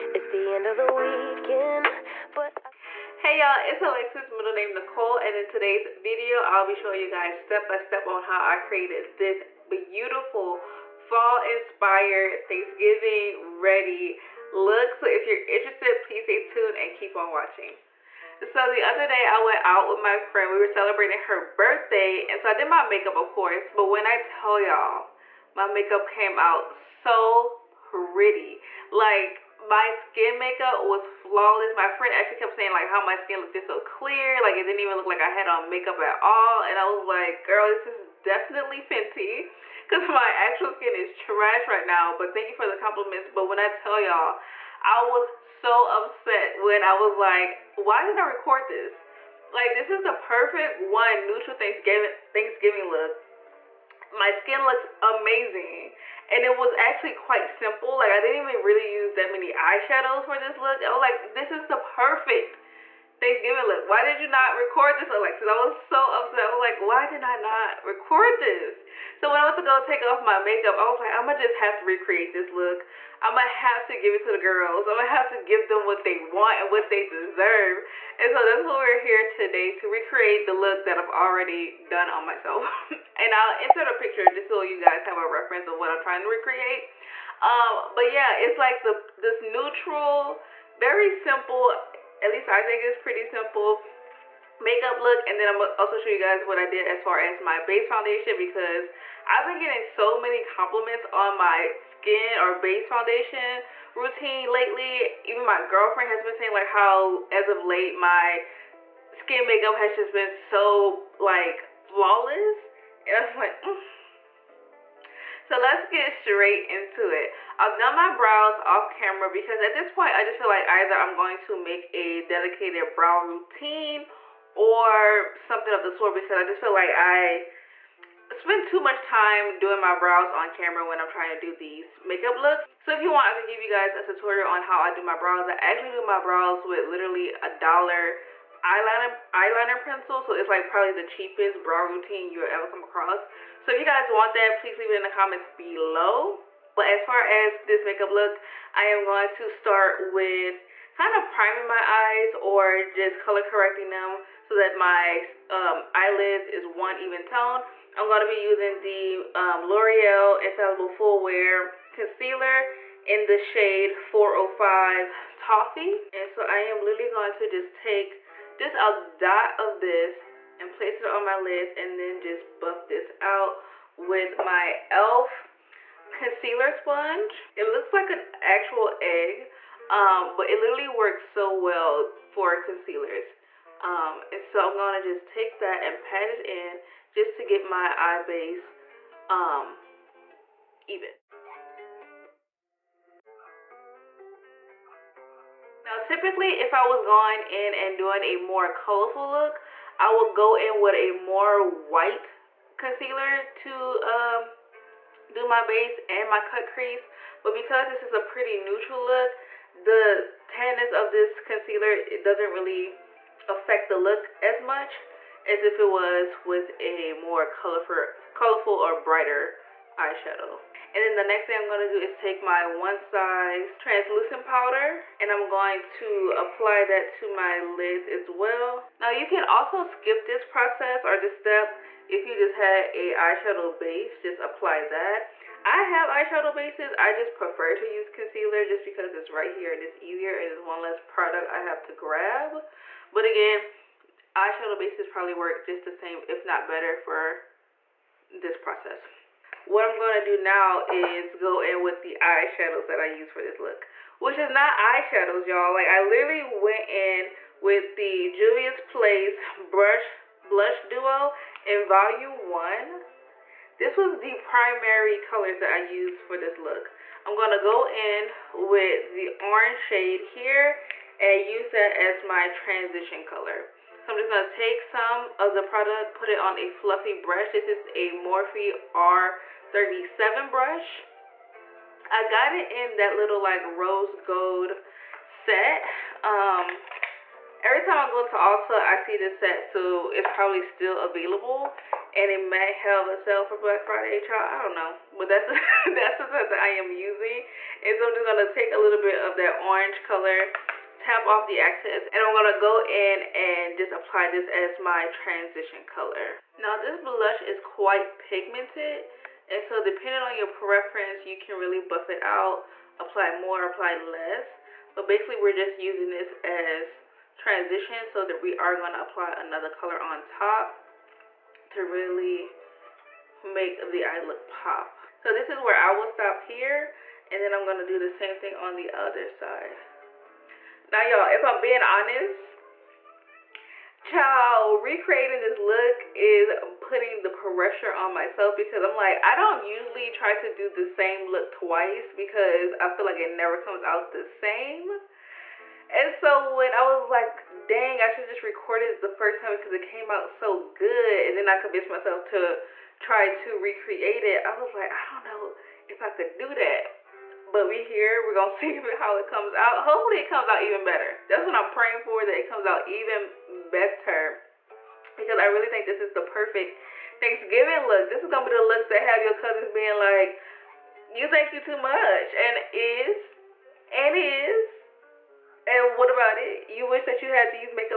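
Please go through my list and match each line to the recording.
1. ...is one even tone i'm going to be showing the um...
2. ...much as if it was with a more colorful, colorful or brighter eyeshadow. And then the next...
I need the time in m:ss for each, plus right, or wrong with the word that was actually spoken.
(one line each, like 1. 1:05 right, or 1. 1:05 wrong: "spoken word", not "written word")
1. 2:36 wrong: "using", not "showing"
2. 3:34 right.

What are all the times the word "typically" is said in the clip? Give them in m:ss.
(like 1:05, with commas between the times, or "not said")
3:16.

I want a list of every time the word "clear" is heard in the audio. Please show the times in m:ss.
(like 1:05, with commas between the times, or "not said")
0:33.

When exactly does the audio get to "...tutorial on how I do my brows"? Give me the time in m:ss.
2:14.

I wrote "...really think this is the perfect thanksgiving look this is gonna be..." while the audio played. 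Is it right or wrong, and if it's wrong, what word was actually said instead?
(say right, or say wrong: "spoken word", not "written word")
right.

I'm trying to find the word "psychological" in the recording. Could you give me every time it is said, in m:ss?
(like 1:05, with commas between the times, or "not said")
not said.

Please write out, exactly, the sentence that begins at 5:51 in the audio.
And then I convinced myself to try to recreate it.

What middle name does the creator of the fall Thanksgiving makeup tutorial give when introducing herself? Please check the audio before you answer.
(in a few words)
Nicole.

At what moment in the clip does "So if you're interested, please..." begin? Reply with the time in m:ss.
0:14.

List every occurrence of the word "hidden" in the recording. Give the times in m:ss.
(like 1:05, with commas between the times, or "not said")
not said.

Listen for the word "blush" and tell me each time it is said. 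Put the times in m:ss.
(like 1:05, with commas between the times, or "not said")
4:20, 5:06.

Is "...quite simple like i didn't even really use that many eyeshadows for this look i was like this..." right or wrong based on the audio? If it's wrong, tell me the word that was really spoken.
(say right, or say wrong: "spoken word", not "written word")
right.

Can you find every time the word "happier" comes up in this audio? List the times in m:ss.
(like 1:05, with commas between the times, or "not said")
not said.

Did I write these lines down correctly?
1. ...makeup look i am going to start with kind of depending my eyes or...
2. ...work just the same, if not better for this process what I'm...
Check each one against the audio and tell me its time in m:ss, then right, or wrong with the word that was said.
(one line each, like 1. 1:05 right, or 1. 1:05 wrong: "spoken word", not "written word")
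1. 2:27 wrong: "priming", not "depending"
2. 4:05 right.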